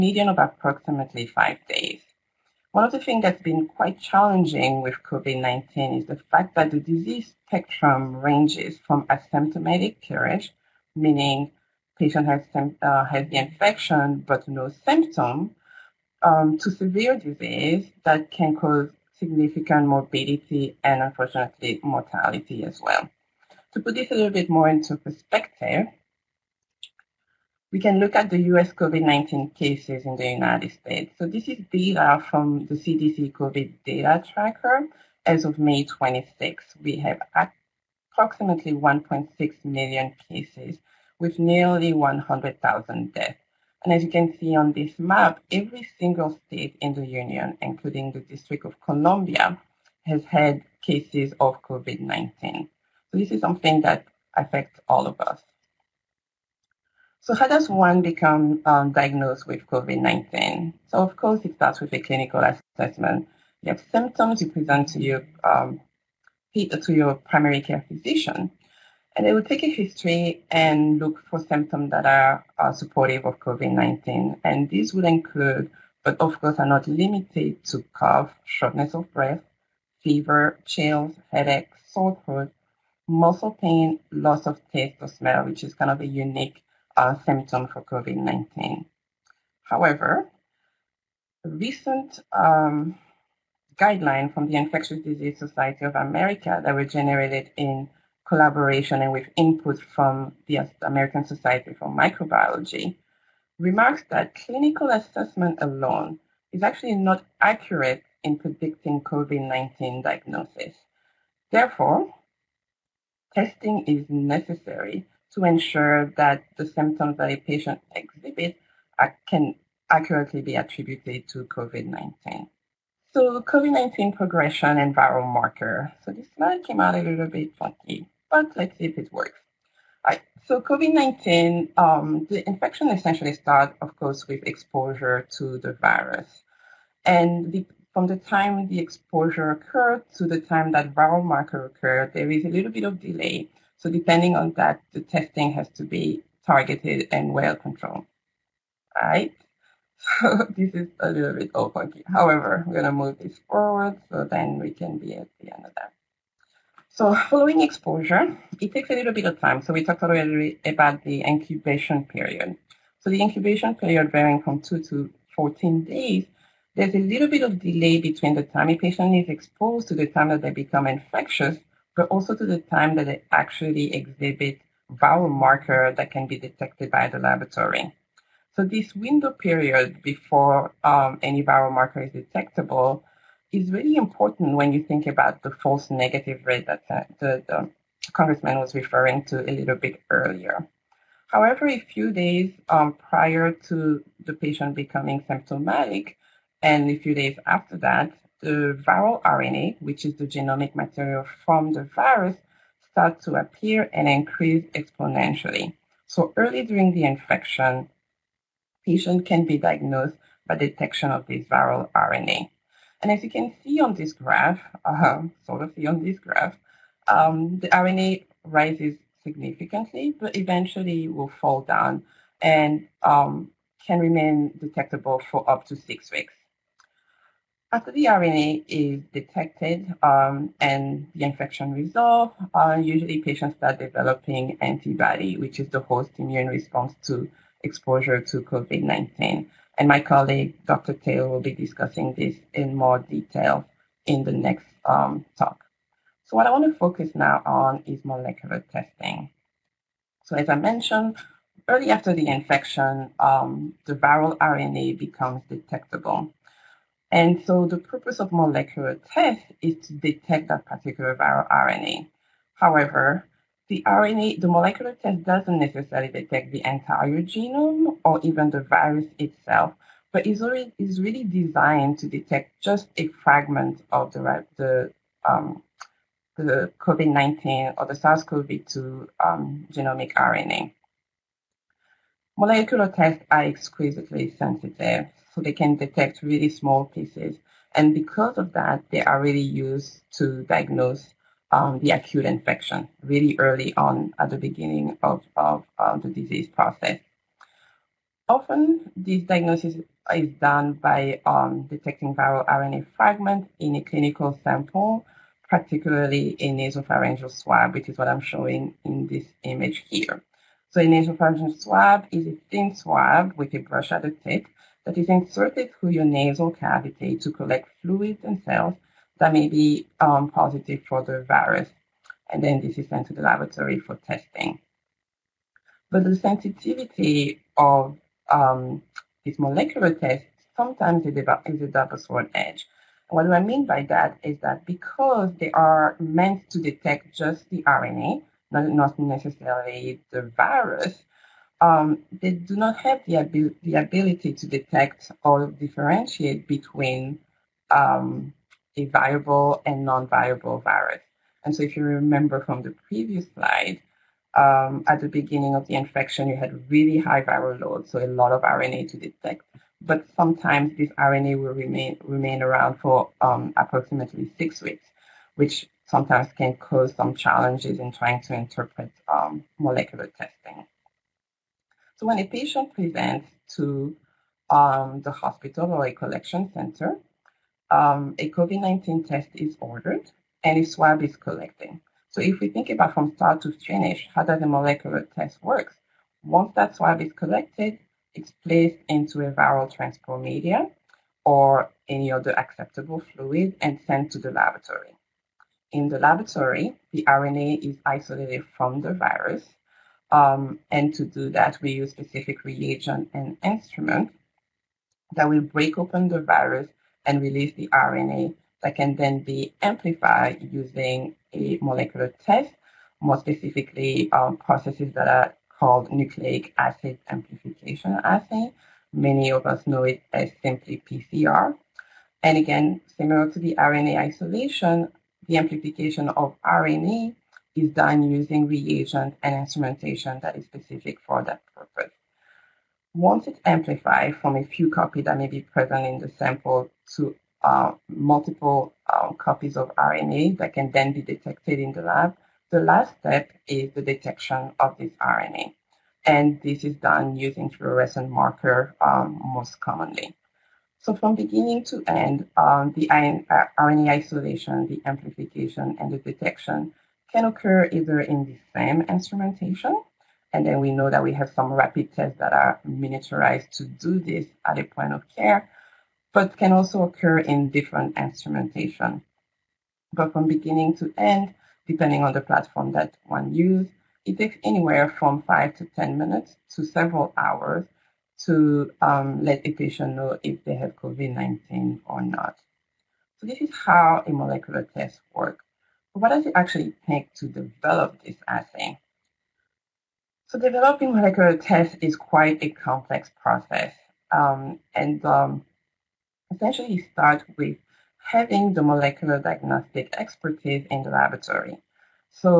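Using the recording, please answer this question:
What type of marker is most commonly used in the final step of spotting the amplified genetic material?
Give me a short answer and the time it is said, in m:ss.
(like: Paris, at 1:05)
fluorescent marker, at 7:27.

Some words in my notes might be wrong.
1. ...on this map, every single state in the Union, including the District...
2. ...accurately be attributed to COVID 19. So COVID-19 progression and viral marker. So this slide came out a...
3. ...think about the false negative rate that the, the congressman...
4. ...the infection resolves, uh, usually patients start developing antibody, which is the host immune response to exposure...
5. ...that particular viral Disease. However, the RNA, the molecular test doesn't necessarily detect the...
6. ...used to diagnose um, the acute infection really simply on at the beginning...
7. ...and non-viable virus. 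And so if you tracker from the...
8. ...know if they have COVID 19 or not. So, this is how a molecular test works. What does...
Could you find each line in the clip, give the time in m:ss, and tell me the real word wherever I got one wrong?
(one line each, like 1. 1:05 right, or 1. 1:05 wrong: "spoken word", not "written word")
1. 0:44 right
2. 1:59 right
3. 3:04 right
4. 3:51 right
5. 4:20 wrong: "RNA", not "Disease"
6. 4:49 wrong: "early", not "simply"
7. 5:49 wrong: "remember", not "tracker"
8. 7:59 right.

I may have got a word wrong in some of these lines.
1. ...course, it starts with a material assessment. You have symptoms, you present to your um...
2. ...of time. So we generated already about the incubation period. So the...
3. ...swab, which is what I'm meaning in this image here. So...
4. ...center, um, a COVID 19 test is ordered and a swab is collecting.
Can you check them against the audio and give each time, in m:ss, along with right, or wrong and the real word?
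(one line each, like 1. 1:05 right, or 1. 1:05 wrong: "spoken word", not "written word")
1. 1:01 wrong: "clinical", not "material"
2. 2:39 wrong: "talked", not "generated"
3. 5:07 wrong: "showing", not "meaning"
4. 6:16 right.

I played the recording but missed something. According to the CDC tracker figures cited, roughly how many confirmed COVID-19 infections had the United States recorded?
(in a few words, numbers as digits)
1.6 million.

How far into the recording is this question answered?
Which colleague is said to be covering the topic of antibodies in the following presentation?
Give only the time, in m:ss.
4:00.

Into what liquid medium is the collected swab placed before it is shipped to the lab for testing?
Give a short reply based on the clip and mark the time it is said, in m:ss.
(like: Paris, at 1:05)
viral transport media, at 6:29.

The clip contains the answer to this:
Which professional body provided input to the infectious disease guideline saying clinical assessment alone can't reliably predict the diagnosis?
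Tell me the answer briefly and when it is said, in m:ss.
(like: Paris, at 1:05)
American Society for Microbiology, at 1:40.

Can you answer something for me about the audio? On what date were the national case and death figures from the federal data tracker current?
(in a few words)
May 26.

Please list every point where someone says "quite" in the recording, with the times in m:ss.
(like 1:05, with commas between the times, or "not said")
0:03, 8:11.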